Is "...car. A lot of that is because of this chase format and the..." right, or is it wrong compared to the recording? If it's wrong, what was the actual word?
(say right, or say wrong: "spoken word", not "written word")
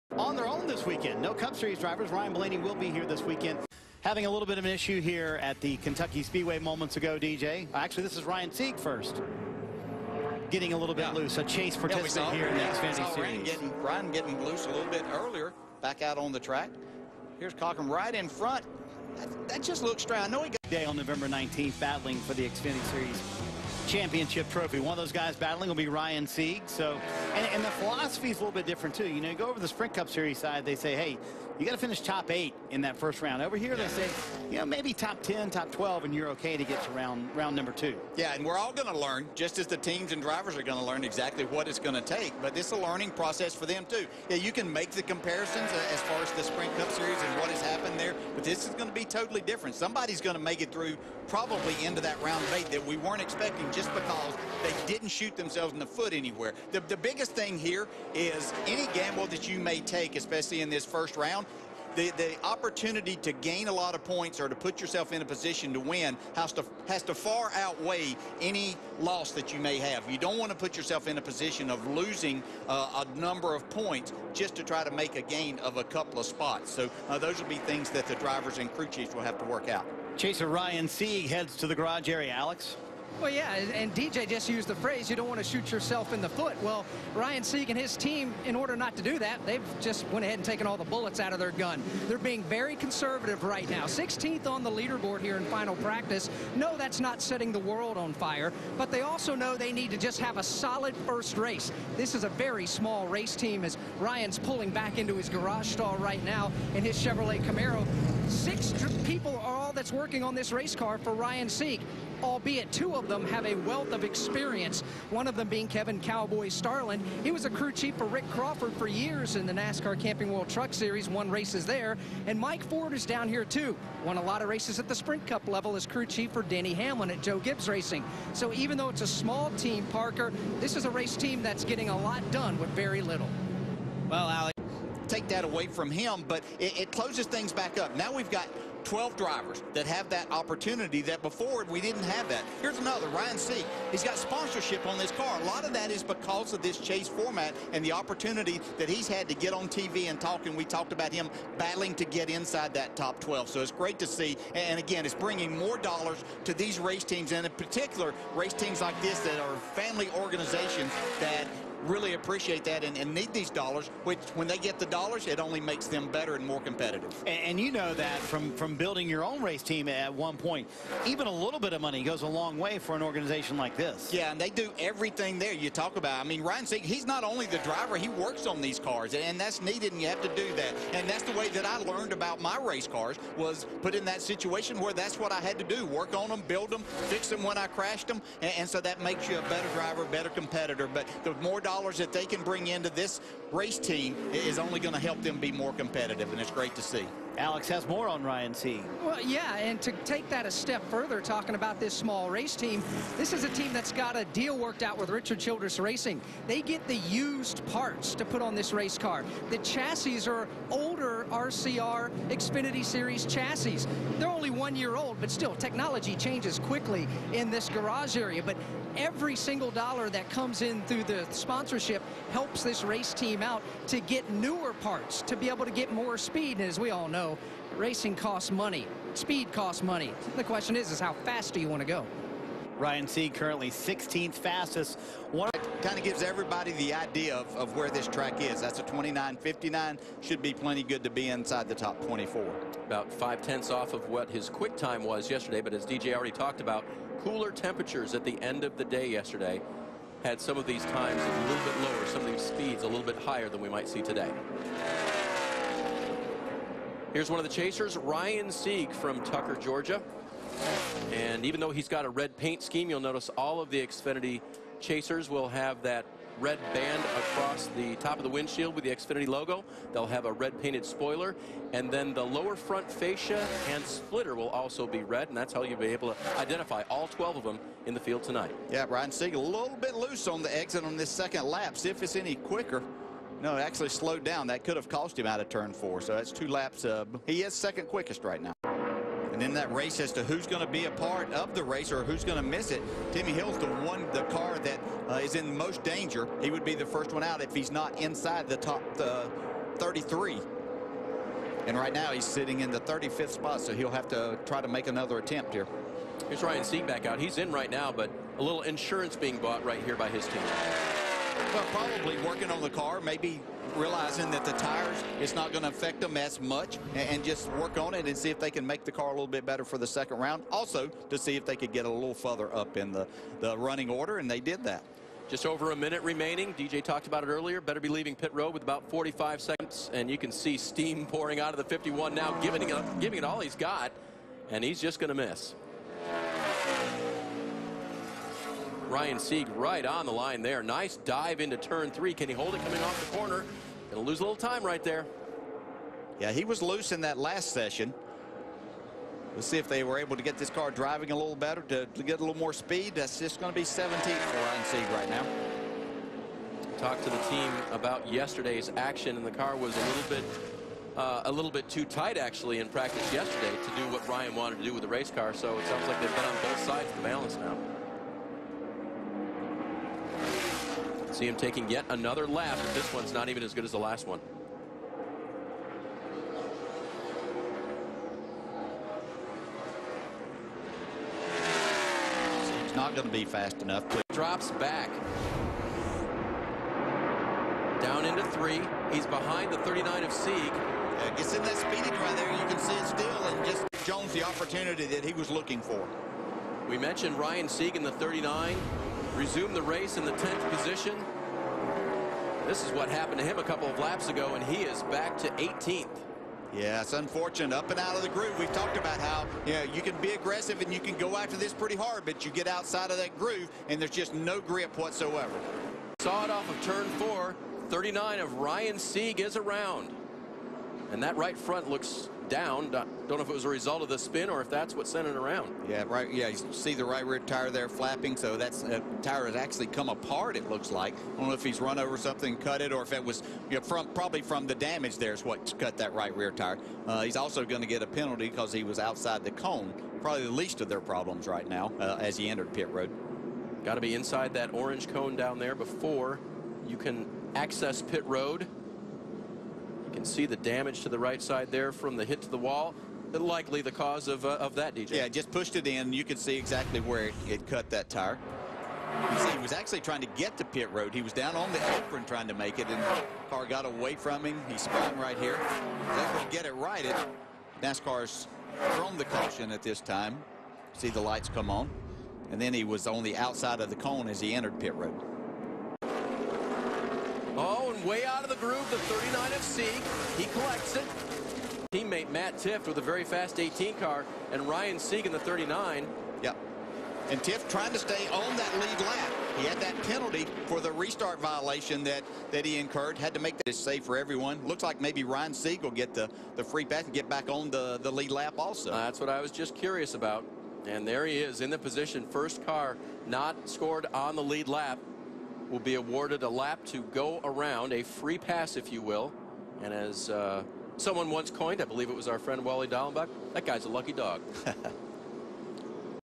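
right.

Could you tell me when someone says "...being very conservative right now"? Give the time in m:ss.
1:32.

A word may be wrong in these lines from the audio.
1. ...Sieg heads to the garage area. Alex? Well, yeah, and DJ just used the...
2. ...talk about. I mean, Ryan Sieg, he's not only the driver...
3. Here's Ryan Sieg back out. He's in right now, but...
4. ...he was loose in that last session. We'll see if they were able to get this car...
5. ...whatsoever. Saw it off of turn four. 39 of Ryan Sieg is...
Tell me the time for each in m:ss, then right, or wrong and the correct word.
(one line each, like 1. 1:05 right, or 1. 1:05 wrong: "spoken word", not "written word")
1. 1:20 right
2. 2:55 right
3. 5:06 right
4. 5:46 right
5. 6:54 right.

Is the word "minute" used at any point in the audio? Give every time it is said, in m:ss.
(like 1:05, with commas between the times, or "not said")
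5:25.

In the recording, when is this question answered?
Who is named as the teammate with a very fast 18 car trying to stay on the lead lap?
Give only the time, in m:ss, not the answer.
8:02.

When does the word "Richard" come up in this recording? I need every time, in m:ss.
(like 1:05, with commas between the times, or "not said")
3:25.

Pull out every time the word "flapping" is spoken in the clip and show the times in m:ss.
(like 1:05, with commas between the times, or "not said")
7:07.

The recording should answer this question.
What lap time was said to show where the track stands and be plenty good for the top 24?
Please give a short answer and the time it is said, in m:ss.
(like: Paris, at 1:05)
29.59, at 3:58.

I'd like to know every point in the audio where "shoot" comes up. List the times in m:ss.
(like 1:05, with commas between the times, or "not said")
0:55, 1:25.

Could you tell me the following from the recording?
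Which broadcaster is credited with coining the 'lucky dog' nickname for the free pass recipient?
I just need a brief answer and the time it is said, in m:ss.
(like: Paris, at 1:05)
Wally Dallenbach, at 8:32.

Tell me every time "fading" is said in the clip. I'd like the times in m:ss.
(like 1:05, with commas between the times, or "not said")
not said.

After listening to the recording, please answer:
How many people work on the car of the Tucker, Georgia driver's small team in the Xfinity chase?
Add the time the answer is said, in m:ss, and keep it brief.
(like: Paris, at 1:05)
Six, at 1:48.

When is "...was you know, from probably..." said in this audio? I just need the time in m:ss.
7:13.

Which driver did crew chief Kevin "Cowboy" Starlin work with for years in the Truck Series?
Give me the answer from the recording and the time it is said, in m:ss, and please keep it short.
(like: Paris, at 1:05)
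Rick Crawford, at 1:58.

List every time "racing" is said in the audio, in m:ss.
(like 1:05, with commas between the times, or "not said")
2:07, 3:25, 3:47.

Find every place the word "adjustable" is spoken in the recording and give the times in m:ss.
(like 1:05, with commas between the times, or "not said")
not said.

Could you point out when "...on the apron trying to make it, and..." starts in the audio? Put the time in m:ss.
7:41.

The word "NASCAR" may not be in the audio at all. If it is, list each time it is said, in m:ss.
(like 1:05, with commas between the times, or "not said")
1:59, 7:47.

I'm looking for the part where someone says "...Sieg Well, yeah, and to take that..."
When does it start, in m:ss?
3:18.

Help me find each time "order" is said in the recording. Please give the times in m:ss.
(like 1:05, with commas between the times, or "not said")
1:28, 5:23.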